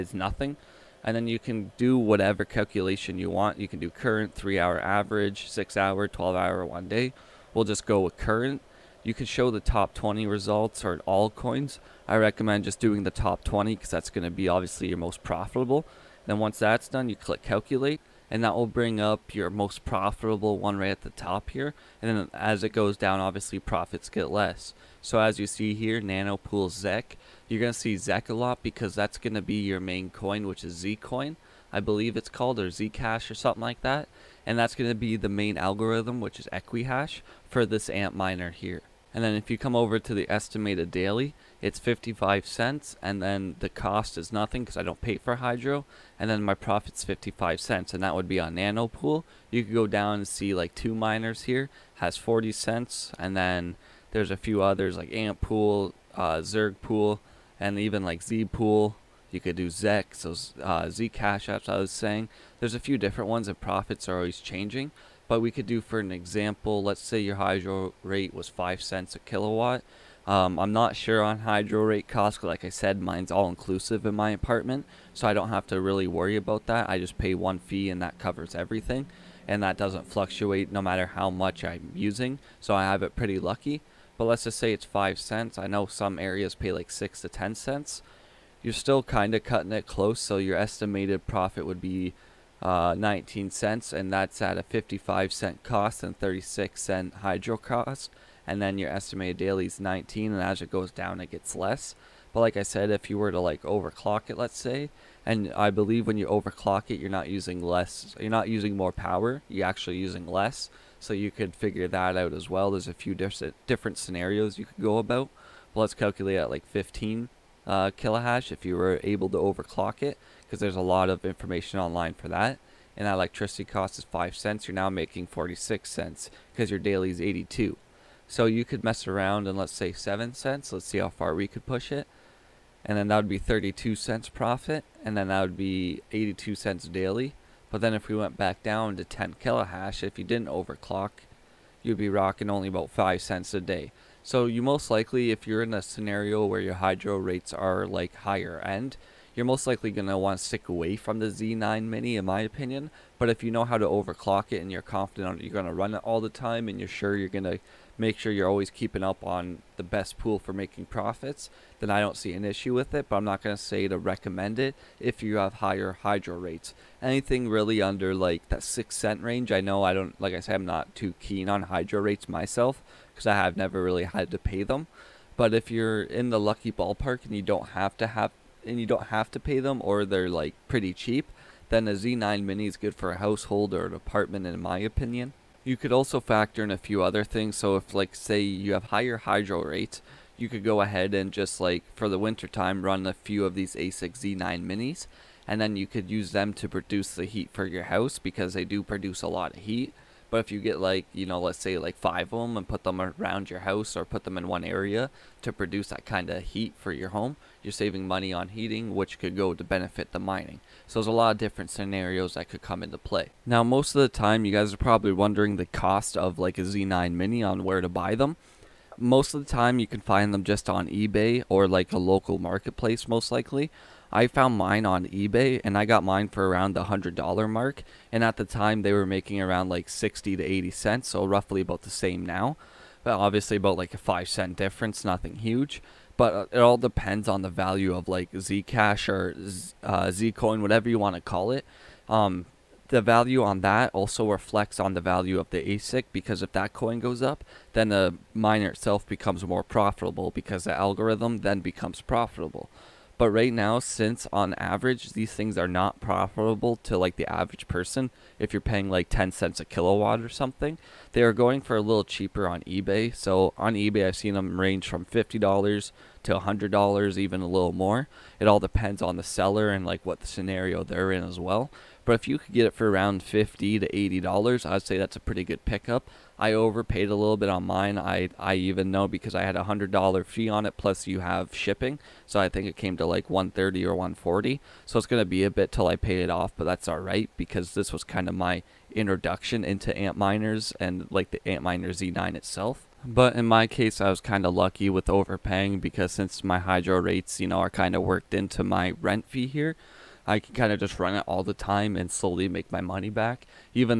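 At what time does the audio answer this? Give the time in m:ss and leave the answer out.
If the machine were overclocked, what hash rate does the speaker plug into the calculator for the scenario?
1:56.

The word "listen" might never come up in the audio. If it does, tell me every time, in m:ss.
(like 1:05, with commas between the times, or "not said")
not said.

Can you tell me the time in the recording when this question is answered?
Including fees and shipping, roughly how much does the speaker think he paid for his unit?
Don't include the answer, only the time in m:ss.
4:43.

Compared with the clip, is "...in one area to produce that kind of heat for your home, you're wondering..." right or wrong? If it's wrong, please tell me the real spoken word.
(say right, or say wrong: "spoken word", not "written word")
wrong: "saving", not "wondering".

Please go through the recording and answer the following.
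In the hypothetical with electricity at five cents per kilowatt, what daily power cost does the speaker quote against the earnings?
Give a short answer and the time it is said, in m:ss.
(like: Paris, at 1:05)
36 cents, at 1:36.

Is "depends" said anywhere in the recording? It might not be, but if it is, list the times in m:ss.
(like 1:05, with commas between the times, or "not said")
3:56, 4:28.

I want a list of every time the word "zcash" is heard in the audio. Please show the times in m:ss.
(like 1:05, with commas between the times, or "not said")
0:32, 1:00, 3:58.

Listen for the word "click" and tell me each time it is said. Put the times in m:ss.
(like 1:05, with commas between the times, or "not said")
0:17.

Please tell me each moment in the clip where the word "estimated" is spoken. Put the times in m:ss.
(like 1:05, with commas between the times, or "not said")
0:40, 1:30, 1:38.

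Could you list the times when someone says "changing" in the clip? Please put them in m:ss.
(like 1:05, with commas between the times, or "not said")
1:04.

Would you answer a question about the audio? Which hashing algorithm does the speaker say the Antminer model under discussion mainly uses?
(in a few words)
Equihash.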